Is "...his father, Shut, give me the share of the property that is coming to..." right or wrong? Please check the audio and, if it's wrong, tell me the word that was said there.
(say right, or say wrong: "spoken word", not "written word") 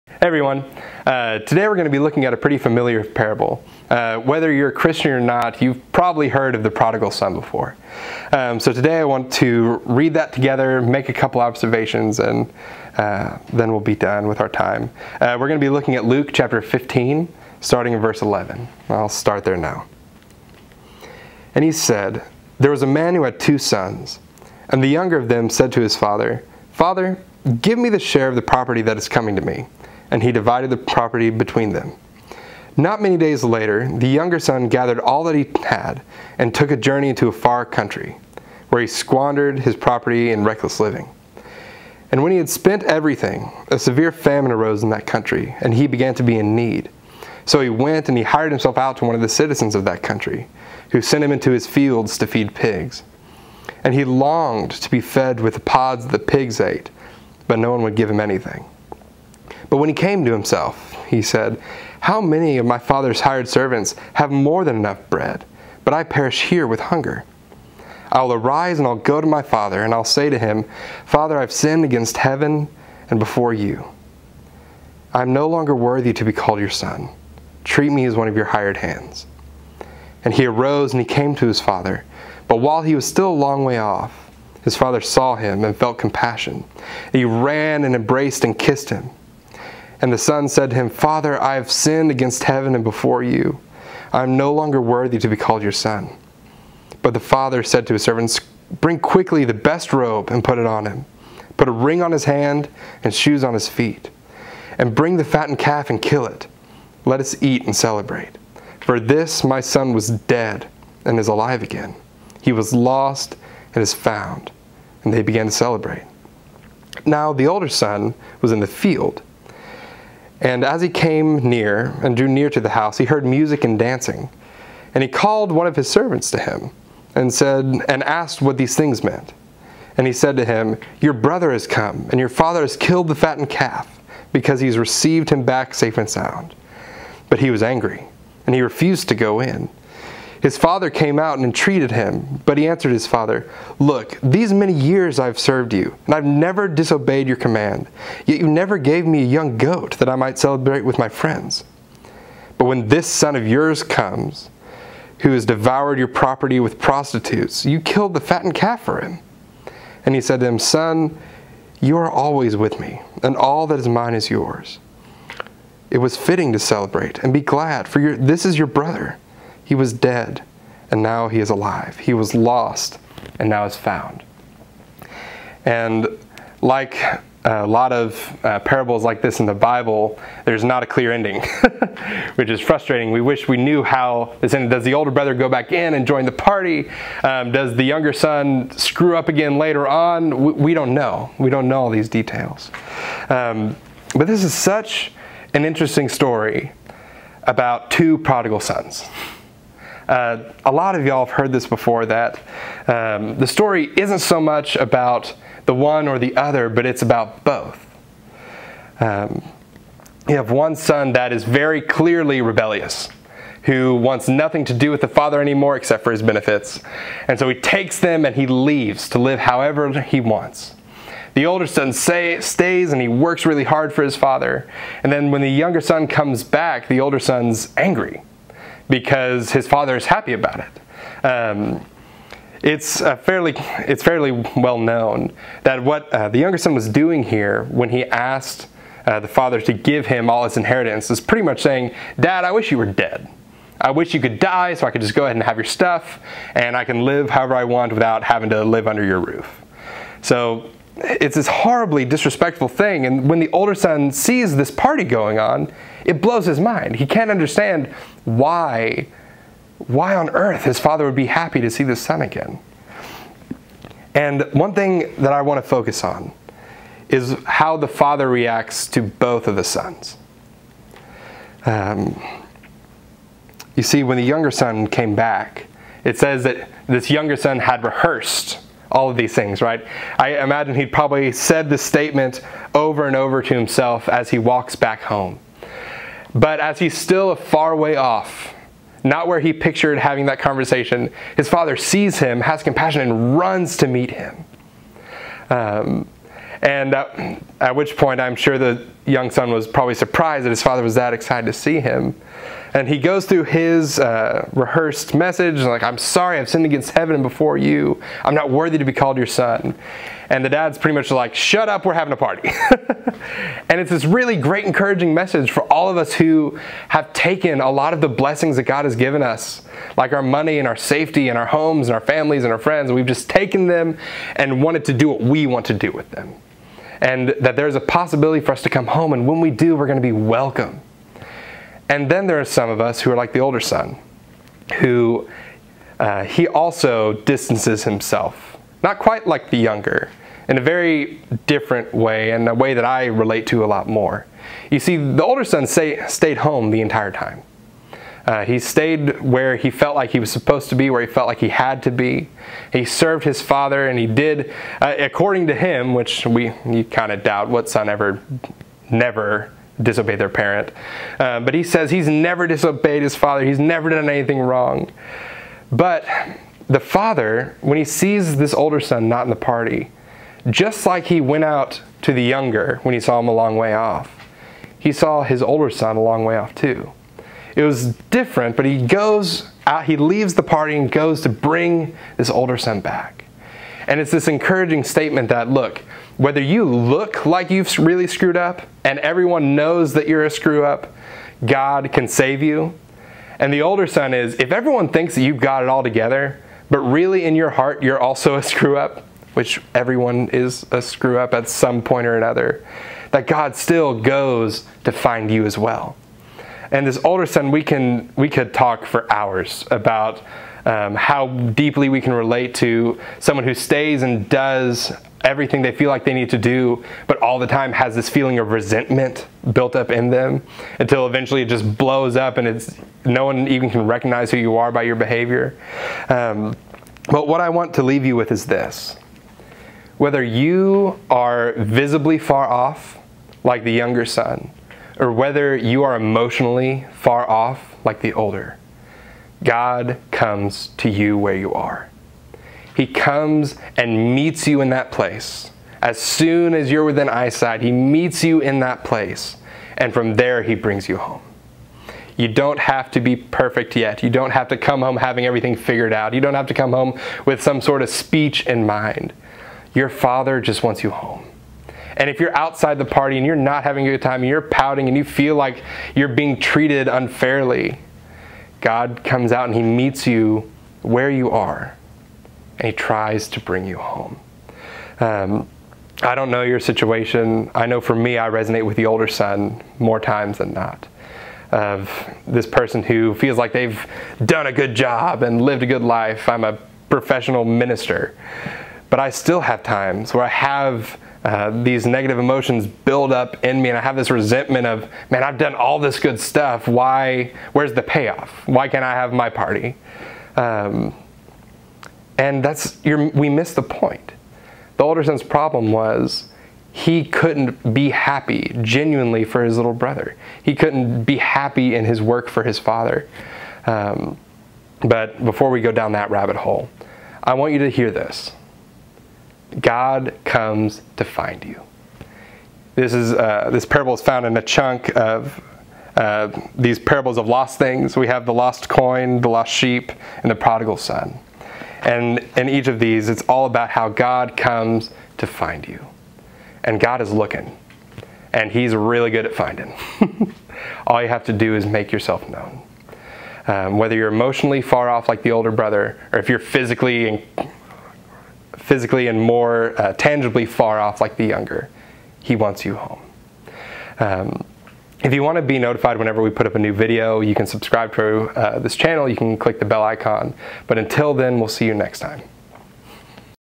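wrong: "Father", not "Shut".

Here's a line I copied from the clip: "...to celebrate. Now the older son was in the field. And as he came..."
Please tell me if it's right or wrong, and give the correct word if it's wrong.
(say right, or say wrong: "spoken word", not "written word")
right.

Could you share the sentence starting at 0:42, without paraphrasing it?
And when he had spent everything, a severe famine arose in that country, and he began to be in need.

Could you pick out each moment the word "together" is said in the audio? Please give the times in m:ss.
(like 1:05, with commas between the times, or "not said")
0:10, 6:35.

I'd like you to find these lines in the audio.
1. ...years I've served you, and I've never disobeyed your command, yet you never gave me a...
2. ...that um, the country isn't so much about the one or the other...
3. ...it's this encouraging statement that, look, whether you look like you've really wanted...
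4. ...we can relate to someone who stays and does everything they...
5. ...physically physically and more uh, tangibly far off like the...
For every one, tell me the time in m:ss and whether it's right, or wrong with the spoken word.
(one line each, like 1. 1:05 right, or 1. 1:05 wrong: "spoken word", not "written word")
1. 2:24 right
2. 3:22 wrong: "story", not "country"
3. 6:23 wrong: "screwed", not "wanted"
4. 6:51 right
5. 9:06 right.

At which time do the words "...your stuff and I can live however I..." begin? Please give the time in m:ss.
4:05.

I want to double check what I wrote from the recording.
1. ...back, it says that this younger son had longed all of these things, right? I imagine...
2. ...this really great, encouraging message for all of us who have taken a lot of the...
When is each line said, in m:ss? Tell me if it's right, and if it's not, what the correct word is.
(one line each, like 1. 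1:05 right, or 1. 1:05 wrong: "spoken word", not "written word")
1. 4:35 wrong: "rehearsed", not "longed"
2. 5:13 right.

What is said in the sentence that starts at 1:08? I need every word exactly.
I'll arise and I'll go to my father, and I'll say to him, Father, I've sinned against heaven and before you.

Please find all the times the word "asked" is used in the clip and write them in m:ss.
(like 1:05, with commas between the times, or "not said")
2:08, 3:58.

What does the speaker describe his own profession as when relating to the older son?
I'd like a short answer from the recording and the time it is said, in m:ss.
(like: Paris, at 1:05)
Professional minister, at 8:06.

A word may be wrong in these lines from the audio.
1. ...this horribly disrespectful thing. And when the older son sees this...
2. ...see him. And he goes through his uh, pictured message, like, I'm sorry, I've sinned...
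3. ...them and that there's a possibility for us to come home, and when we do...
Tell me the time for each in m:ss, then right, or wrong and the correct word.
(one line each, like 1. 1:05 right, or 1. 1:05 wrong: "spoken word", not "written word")
1. 4:11 right
2. 5:01 wrong: "rehearsed", not "pictured"
3. 5:26 right.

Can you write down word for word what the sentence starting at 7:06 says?
Um, but what I want to leave you with is this.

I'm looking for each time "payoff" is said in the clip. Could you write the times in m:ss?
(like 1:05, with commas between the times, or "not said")
8:17.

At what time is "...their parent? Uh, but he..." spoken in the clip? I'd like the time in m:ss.
6:00.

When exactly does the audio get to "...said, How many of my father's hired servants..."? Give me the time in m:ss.
1:01.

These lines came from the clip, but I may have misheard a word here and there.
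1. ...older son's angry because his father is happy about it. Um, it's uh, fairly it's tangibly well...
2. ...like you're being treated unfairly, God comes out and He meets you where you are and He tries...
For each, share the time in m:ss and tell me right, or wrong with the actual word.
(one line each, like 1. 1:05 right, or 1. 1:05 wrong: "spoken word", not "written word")
1. 3:46 wrong: "fairly", not "tangibly"
2. 7:45 right.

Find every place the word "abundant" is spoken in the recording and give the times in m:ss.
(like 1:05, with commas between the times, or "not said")
not said.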